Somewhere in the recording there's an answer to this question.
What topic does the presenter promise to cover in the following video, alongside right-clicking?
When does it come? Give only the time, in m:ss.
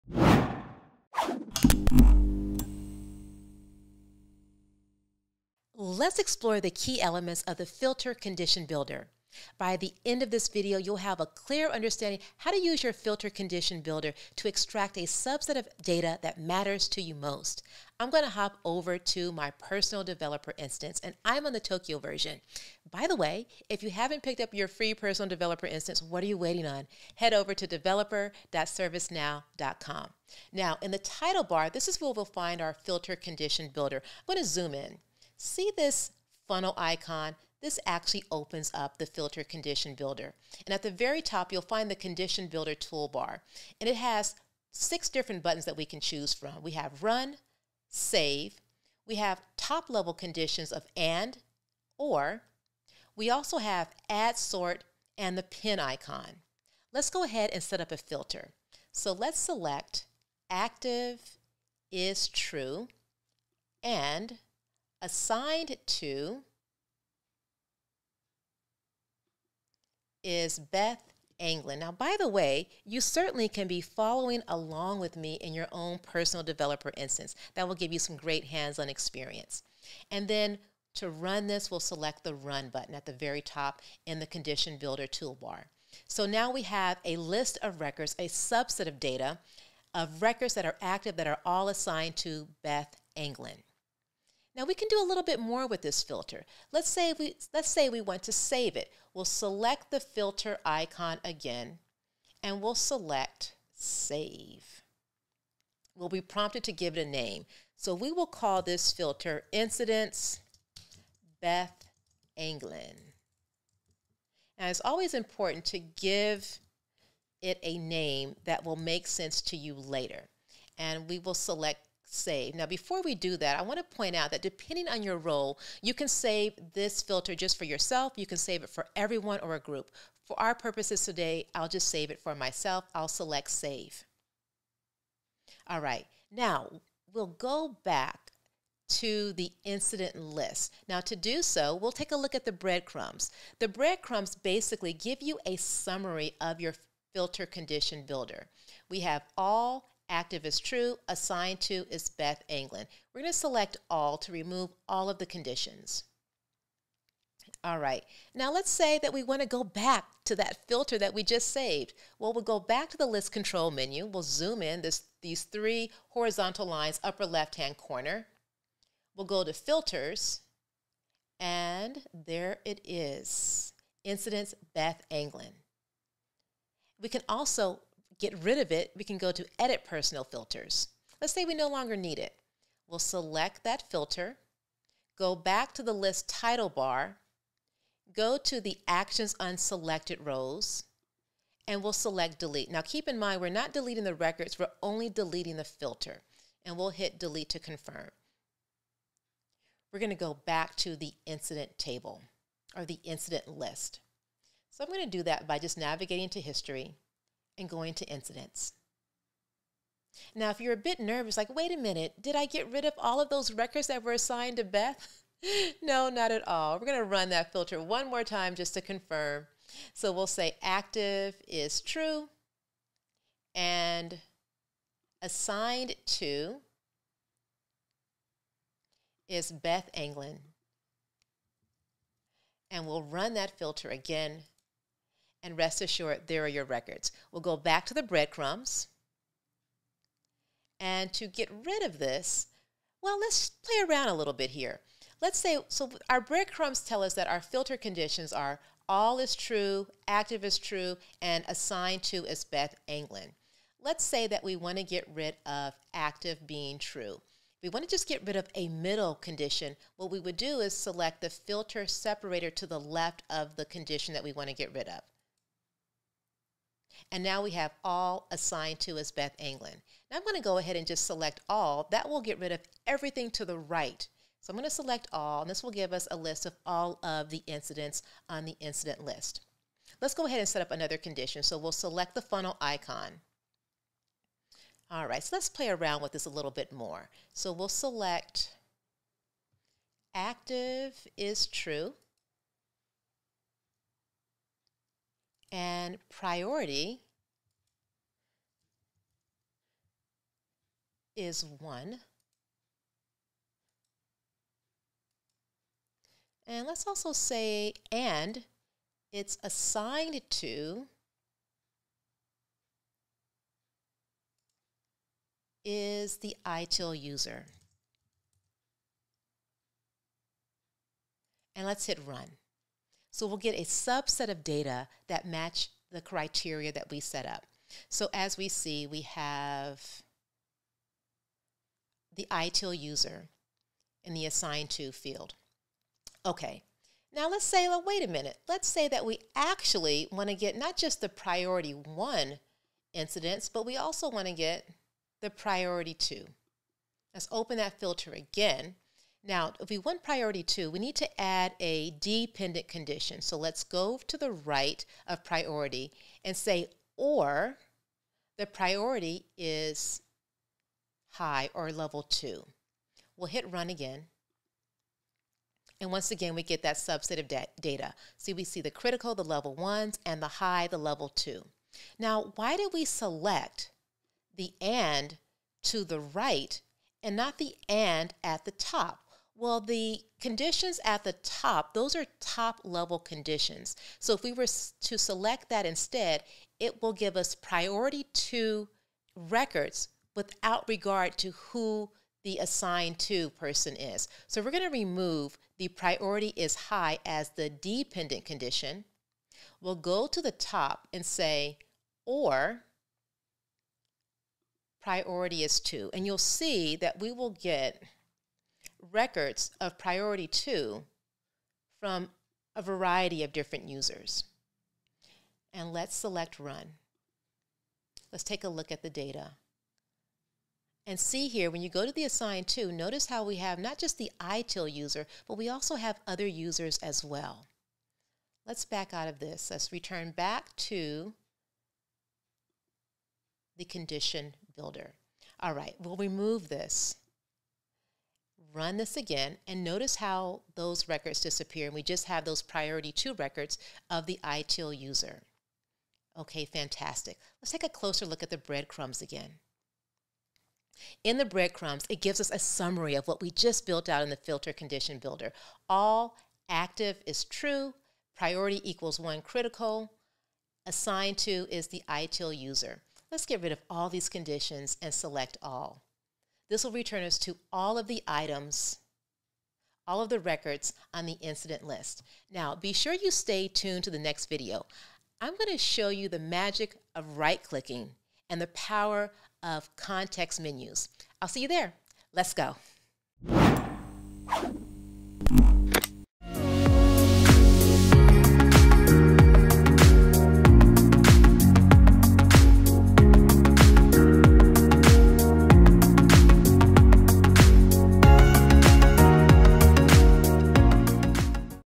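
7:59.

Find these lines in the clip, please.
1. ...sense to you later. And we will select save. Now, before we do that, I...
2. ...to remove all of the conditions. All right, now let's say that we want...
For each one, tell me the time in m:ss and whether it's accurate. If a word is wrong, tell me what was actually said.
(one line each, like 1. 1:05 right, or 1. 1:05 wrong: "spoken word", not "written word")
1. 1:59 right
2. 2:34 right.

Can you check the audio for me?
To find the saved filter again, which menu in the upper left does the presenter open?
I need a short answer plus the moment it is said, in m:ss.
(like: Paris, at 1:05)
list control menu, at 2:43.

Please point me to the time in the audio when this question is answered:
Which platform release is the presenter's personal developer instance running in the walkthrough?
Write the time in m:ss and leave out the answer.
0:21.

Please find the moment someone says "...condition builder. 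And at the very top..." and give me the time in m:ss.
0:39.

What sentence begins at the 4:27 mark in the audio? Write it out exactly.
And now we have all assigned to as Beth Anglin.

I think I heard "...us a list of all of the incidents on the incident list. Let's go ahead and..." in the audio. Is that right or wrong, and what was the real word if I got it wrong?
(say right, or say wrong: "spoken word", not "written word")
right.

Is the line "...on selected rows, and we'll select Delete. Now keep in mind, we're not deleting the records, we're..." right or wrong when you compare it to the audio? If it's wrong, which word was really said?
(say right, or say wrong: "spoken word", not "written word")
right.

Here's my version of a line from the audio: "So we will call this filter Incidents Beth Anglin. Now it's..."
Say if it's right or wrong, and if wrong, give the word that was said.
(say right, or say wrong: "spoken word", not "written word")
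right.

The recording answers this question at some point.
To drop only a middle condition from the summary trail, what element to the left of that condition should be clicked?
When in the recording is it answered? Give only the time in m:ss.
4:21.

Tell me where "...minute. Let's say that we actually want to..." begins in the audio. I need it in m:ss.
5:38.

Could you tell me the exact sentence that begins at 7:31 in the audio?
In the breadcrumbs, it gives us a summary of what we just built out in the filter condition builder.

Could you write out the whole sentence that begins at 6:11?
Now, why did we select the and to the right and not the and at the top?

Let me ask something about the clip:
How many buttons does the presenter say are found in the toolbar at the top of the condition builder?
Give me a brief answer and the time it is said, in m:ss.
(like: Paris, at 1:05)
6, at 0:44.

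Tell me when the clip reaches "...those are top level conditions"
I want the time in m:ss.
6:21.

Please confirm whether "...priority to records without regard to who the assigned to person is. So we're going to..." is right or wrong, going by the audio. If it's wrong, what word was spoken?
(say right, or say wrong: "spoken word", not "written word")
right.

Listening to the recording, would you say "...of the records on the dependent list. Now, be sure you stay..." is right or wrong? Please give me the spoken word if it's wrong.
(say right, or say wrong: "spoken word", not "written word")
wrong: "incident", not "dependent".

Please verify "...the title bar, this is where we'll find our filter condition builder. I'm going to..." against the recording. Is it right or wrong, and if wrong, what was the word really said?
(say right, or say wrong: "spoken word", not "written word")
right.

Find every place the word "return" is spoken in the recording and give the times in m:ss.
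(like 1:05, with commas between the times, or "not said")
7:09, 7:46.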